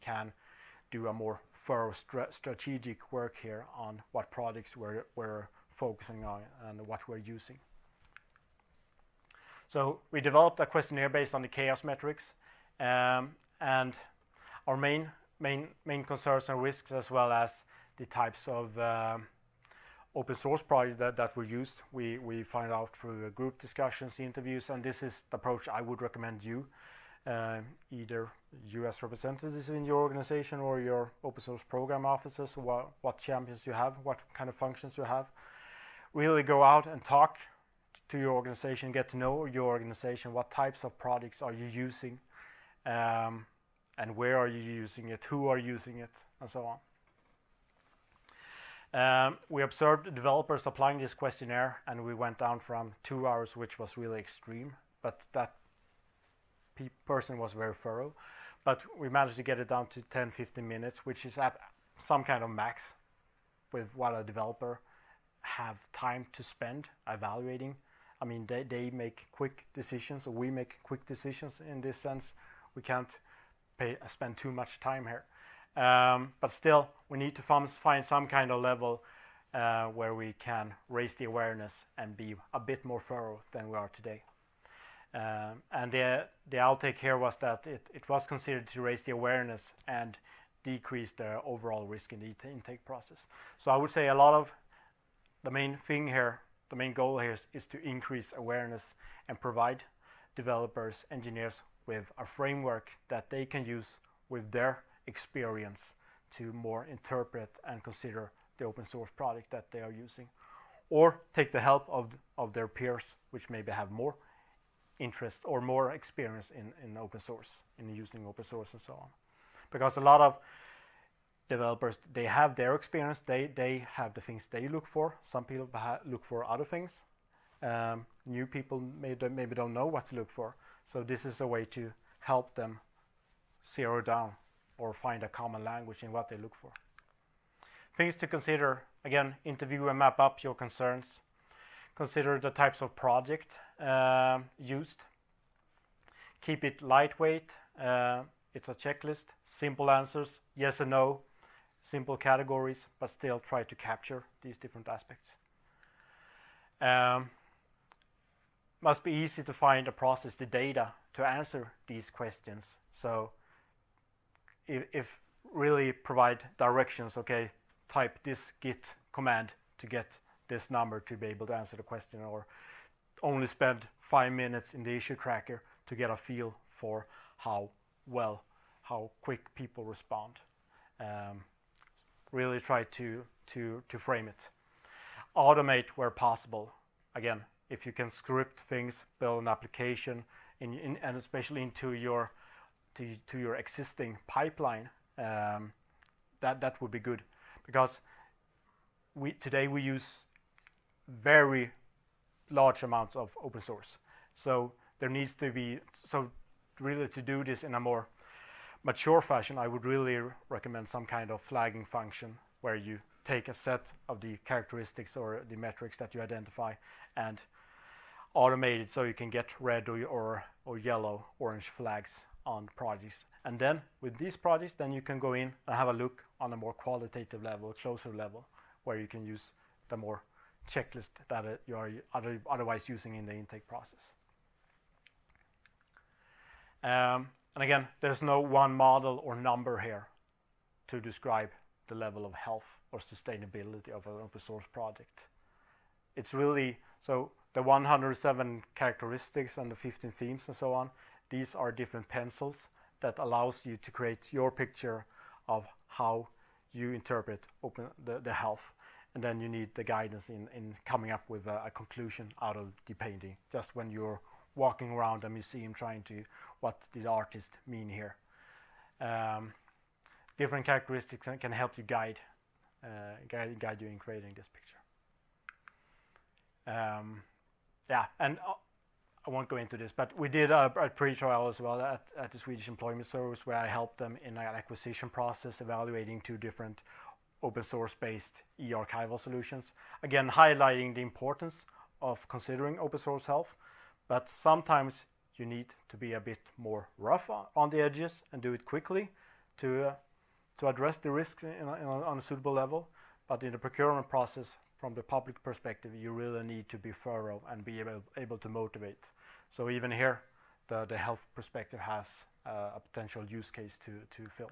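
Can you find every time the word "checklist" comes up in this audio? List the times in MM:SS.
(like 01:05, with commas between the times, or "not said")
02:28, 03:50.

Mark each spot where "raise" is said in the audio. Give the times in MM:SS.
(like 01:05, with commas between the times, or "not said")
01:20, 01:28.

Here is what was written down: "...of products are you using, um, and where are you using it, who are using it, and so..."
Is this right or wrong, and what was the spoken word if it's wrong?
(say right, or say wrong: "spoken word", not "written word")
right.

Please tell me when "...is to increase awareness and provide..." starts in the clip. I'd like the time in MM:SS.
01:37.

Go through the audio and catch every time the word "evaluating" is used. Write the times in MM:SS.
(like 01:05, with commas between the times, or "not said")
01:07, 04:45.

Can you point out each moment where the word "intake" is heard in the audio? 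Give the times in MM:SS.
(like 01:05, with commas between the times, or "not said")
01:32, 03:53.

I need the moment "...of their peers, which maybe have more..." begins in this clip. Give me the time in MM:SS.
01:52.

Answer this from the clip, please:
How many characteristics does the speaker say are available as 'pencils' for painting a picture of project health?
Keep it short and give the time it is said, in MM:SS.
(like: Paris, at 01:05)
107, at 04:07.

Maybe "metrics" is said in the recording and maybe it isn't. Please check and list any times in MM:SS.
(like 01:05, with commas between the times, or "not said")
00:11, 03:35.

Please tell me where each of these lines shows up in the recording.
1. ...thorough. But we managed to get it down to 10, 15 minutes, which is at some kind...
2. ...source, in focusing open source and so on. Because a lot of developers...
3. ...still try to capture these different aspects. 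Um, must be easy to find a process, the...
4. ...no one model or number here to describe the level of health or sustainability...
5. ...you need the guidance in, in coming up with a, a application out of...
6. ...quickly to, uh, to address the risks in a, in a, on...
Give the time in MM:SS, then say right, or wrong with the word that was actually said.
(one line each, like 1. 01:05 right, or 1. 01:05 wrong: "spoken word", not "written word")
1. 00:57 right
2. 01:57 wrong: "using", not "focusing"
3. 02:33 right
4. 03:58 right
5. 04:19 wrong: "conclusion", not "application"
6. 04:58 right.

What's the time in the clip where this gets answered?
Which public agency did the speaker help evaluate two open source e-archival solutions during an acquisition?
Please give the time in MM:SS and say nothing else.
04:42.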